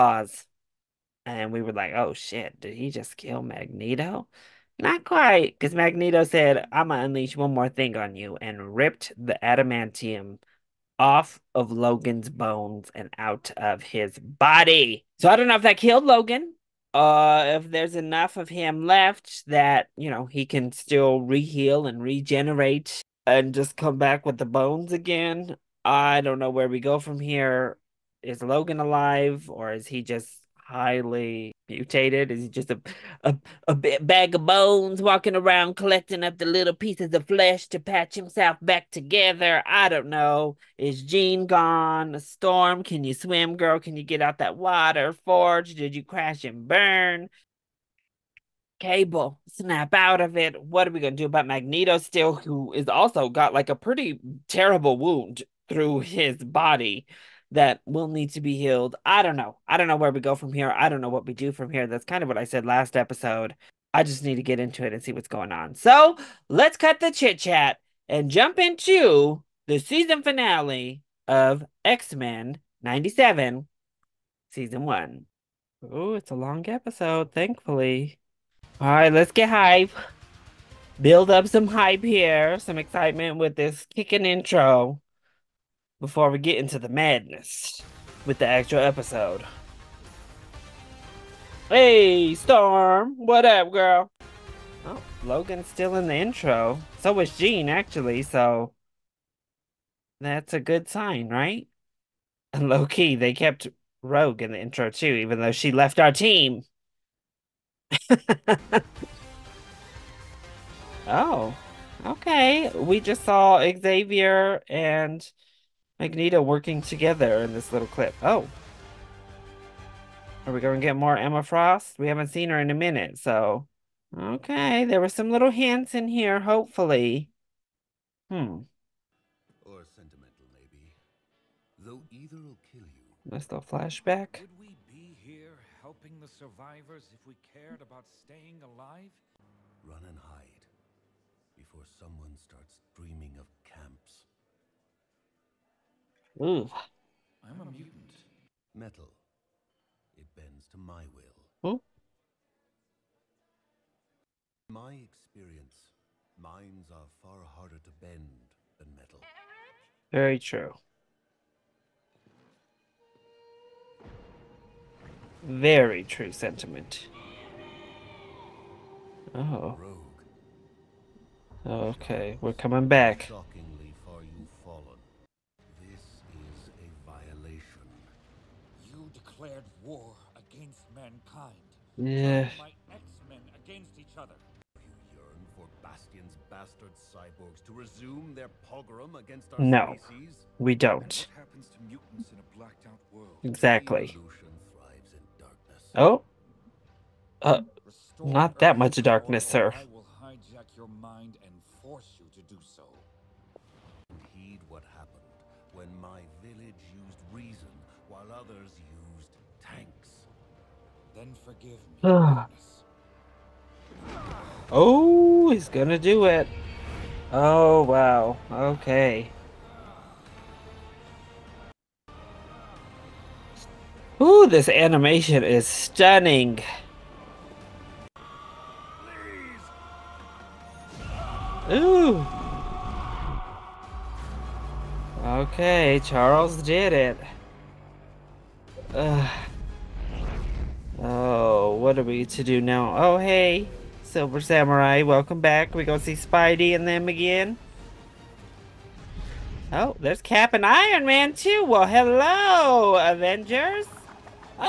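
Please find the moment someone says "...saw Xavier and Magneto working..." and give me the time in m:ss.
1:53.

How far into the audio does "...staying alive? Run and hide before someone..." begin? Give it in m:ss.
2:18.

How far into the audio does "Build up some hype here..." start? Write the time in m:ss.
1:20.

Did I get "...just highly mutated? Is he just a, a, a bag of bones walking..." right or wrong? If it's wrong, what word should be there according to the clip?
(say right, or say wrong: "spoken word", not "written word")
right.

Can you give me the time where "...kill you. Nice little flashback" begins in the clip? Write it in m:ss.
2:12.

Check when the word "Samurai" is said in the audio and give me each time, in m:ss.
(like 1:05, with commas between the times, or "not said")
4:04.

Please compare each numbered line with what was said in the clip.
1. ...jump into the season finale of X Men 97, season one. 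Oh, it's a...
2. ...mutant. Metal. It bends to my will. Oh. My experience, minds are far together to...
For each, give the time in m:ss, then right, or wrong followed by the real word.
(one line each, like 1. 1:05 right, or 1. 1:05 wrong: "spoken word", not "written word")
1. 1:08 right
2. 2:27 wrong: "harder", not "together".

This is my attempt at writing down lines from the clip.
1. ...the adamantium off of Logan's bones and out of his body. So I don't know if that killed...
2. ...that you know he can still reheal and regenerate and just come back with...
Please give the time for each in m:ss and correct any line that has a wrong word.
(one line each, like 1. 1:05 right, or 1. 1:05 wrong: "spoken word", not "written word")
1. 0:09 right
2. 0:19 right.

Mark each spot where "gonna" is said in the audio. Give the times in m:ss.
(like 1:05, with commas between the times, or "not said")
3:35, 4:05.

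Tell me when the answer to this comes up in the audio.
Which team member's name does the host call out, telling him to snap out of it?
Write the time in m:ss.
0:48.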